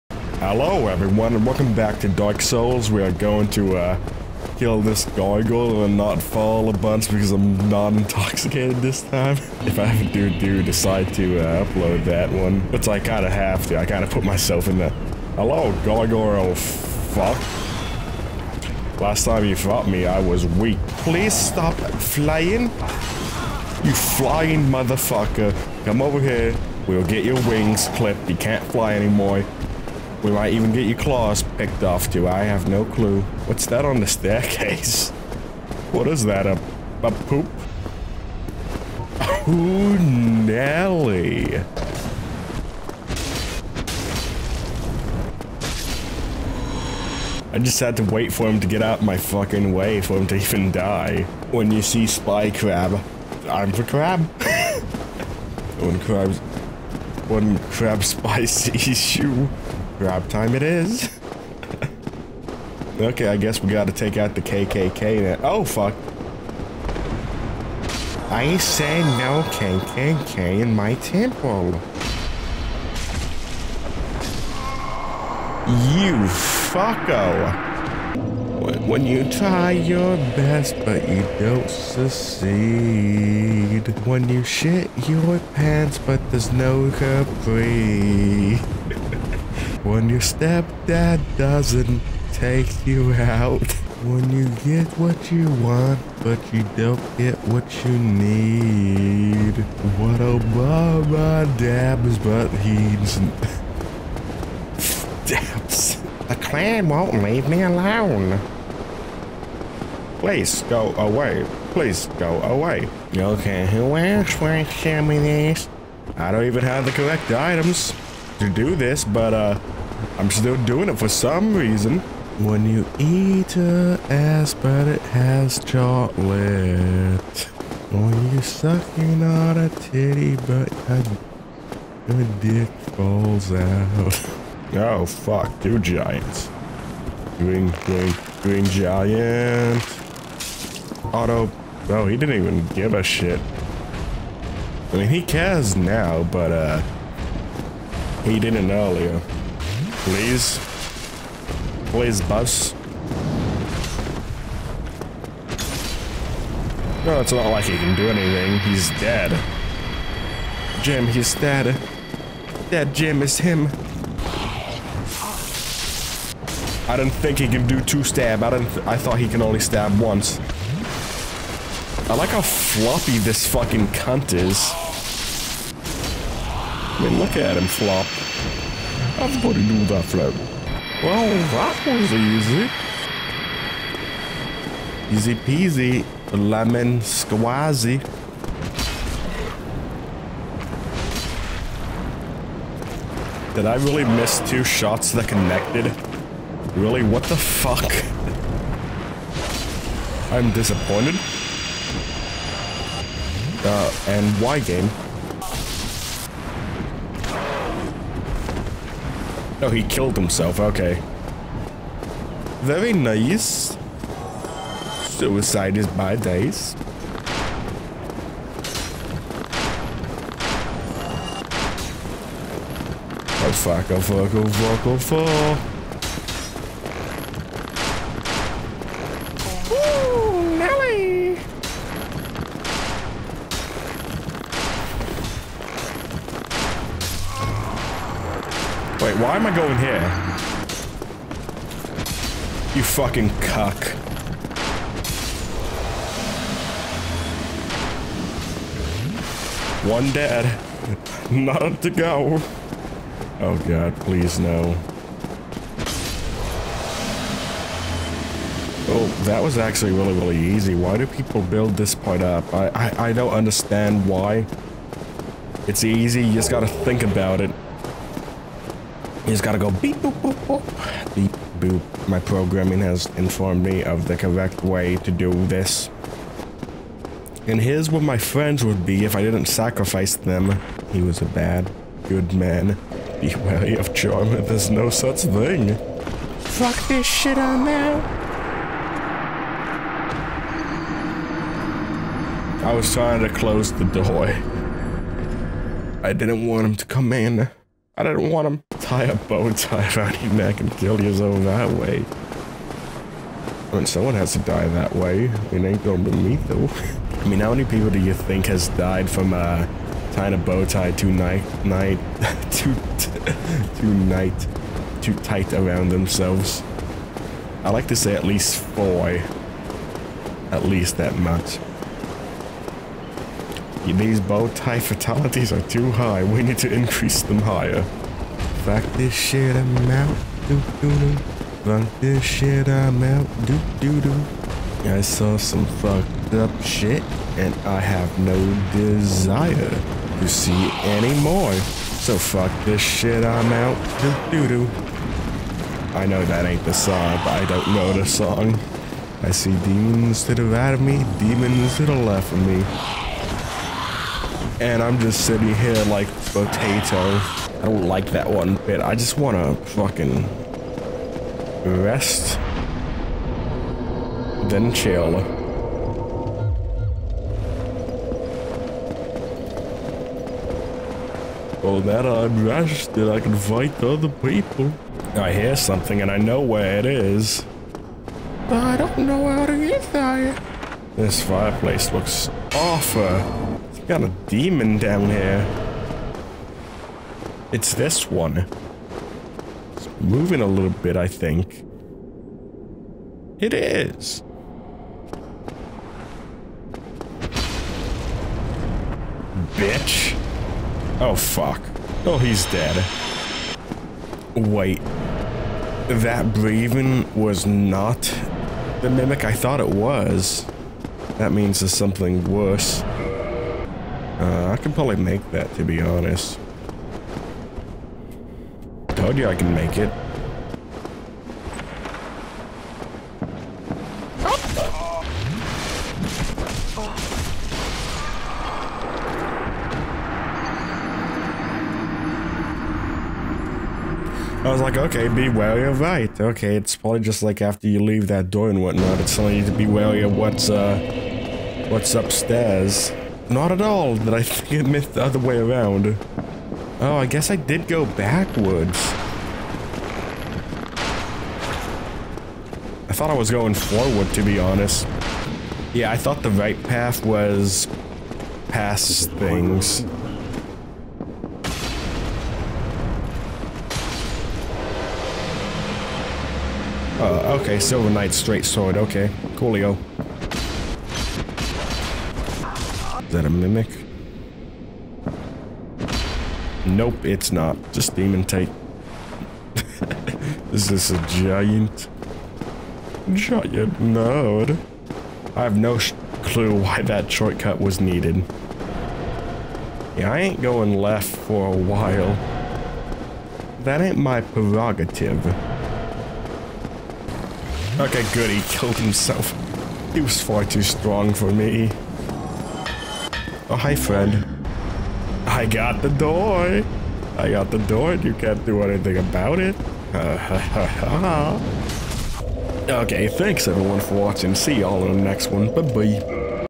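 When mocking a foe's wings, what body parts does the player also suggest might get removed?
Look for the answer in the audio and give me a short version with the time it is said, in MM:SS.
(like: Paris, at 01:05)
claws, at 00:30.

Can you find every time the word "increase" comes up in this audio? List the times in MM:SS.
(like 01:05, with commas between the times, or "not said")
05:26.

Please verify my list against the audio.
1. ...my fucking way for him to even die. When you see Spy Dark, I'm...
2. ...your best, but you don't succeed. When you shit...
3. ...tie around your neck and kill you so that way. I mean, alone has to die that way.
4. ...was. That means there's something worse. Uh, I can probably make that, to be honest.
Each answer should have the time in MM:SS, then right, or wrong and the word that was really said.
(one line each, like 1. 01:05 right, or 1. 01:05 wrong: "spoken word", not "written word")
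1. 00:49 wrong: "Crab", not "Dark"
2. 01:19 right
3. 04:59 wrong: "someone", not "alone"
4. 06:49 right.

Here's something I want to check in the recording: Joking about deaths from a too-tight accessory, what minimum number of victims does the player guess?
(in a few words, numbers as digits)
4.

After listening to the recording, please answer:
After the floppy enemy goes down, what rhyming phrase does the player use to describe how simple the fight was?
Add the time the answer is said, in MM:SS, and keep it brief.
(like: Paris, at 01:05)
Easy peasy, lemon squazy, at 03:05.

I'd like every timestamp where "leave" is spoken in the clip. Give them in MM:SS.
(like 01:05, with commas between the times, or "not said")
01:47, 07:17.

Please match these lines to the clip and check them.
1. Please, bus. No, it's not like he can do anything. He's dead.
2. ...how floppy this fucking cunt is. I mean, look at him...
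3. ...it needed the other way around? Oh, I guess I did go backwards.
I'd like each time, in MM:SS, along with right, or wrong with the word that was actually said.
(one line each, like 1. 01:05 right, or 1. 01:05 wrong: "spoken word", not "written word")
1. 02:31 right
2. 02:52 right
3. 07:24 wrong: "missed", not "needed".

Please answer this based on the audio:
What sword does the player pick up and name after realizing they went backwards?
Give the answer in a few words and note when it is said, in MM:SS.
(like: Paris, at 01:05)
Silver Knight straight sword, at 07:47.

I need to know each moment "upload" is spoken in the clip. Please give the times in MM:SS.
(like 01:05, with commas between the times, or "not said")
00:11.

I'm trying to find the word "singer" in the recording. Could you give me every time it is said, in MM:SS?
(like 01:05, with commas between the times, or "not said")
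not said.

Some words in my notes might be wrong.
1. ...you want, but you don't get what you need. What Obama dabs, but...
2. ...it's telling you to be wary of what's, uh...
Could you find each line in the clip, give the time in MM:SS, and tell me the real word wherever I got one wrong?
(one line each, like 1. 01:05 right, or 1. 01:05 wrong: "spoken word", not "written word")
1. 01:35 right
2. 07:18 right.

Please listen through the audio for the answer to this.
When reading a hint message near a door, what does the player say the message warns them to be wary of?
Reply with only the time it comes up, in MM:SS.
04:43.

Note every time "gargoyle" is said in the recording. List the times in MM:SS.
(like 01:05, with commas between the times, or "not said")
00:05, 00:15.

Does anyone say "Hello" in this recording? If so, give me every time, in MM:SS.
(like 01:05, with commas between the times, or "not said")
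00:00, 00:15.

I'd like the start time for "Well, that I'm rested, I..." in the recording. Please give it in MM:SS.
06:11.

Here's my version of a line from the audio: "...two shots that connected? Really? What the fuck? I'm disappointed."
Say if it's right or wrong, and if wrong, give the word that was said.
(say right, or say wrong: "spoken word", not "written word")
right.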